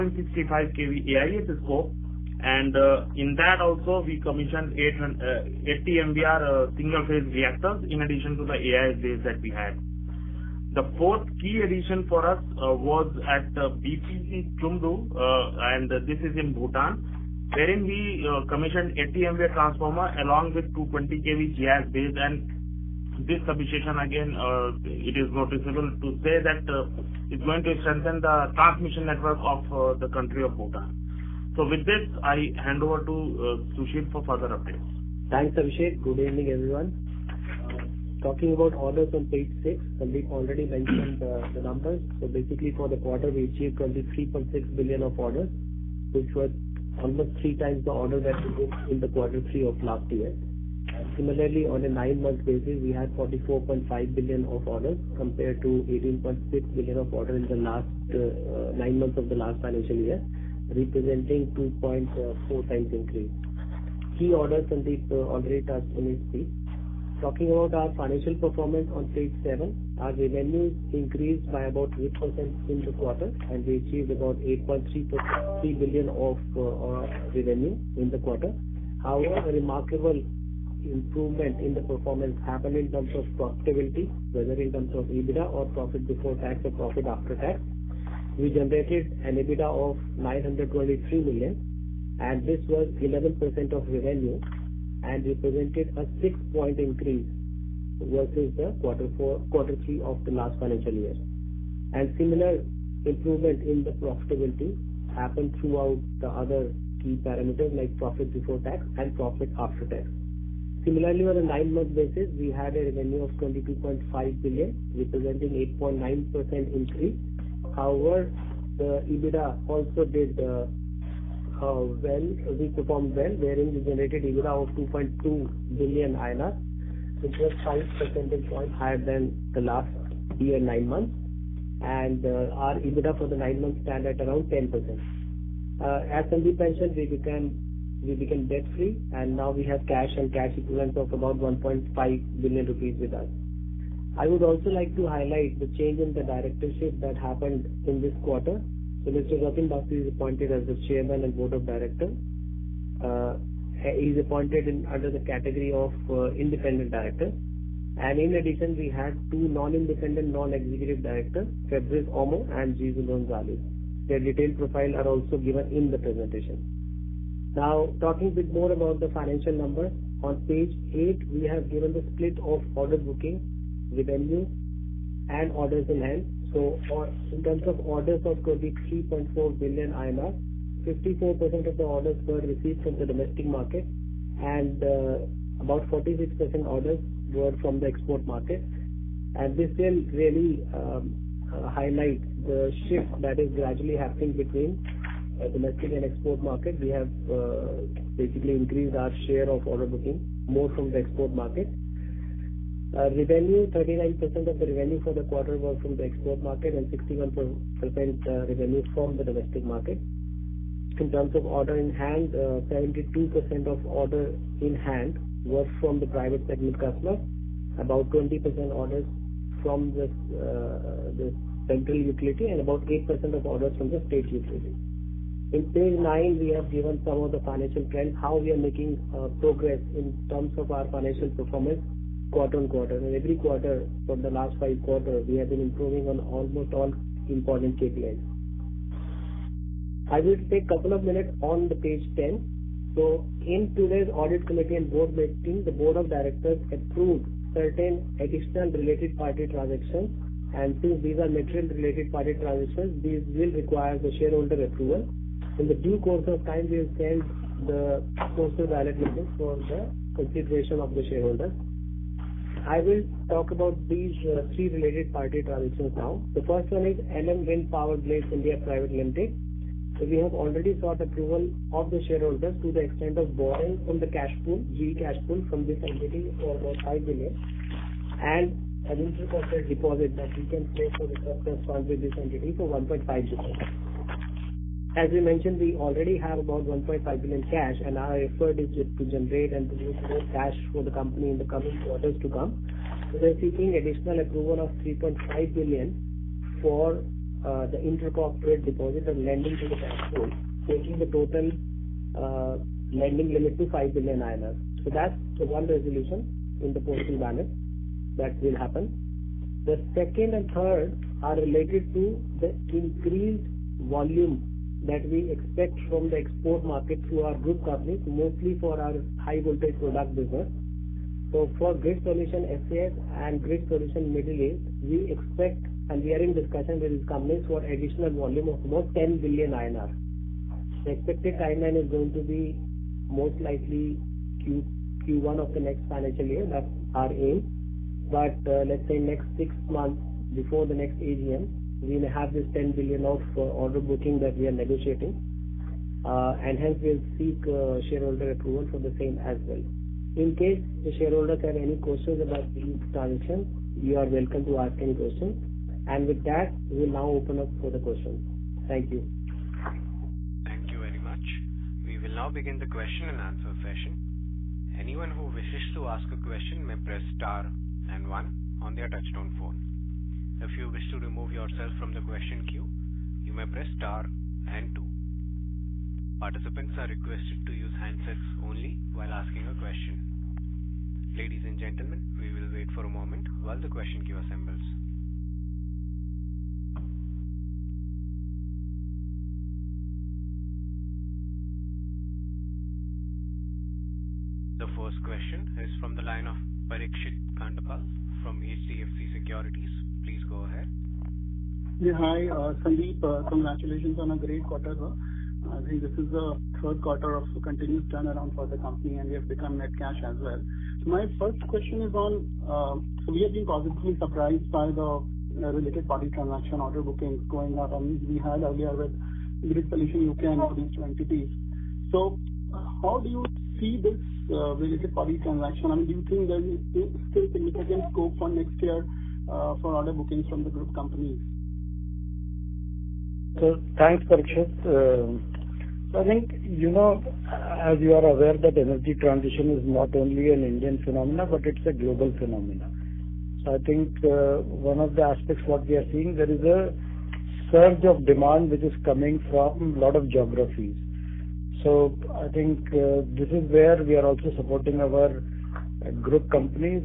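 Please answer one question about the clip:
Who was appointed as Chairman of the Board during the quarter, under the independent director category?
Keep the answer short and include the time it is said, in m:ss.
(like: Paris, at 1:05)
Jatin Bakshi, at 2:29.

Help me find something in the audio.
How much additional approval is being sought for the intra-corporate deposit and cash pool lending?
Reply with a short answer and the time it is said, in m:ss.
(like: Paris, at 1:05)
3.5 billion, at 4:54.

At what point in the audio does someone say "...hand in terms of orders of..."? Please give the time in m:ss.
2:55.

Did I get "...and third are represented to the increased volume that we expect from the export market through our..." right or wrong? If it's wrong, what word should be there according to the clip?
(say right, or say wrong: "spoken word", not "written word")
wrong: "related", not "represented".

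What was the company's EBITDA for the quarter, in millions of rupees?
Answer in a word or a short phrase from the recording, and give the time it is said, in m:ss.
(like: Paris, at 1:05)
923 million, at 1:30.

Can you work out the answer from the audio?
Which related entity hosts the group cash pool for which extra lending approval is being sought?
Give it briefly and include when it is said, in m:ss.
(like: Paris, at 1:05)
LM Wind Power Blades India, at 4:27.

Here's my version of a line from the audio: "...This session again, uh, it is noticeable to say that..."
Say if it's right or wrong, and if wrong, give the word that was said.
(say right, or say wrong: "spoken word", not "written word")
wrong: "substation", not "session".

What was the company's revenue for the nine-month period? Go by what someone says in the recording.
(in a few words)
22.5 billion.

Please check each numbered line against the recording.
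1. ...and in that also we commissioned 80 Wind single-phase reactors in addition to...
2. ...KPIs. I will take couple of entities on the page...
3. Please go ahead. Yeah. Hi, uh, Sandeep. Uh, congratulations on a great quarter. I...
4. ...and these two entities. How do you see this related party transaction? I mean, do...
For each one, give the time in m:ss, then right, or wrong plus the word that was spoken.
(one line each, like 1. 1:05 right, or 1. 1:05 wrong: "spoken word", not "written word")
1. 0:02 wrong: "MVAR", not "Wind"
2. 3:57 wrong: "minutes", not "entities"
3. 6:40 right
4. 7:00 right.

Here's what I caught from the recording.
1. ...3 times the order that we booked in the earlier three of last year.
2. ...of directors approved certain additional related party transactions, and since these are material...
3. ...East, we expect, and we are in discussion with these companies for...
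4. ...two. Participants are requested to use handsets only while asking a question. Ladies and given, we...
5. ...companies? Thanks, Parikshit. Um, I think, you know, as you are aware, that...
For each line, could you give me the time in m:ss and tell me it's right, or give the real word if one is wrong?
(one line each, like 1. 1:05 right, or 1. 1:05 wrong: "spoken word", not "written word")
1. 0:47 wrong: "quarter", not "earlier"
2. 4:05 right
3. 5:24 right
4. 6:14 wrong: "gentlemen", not "given"
5. 7:10 right.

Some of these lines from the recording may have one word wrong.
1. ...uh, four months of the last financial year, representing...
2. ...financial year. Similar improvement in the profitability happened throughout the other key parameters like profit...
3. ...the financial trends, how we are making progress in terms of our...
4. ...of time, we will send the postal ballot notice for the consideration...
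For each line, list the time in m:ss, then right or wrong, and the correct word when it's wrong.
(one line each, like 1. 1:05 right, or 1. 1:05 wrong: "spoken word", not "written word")
1. 0:58 wrong: "nine", not "four"
2. 1:40 right
3. 3:47 right
4. 4:16 right.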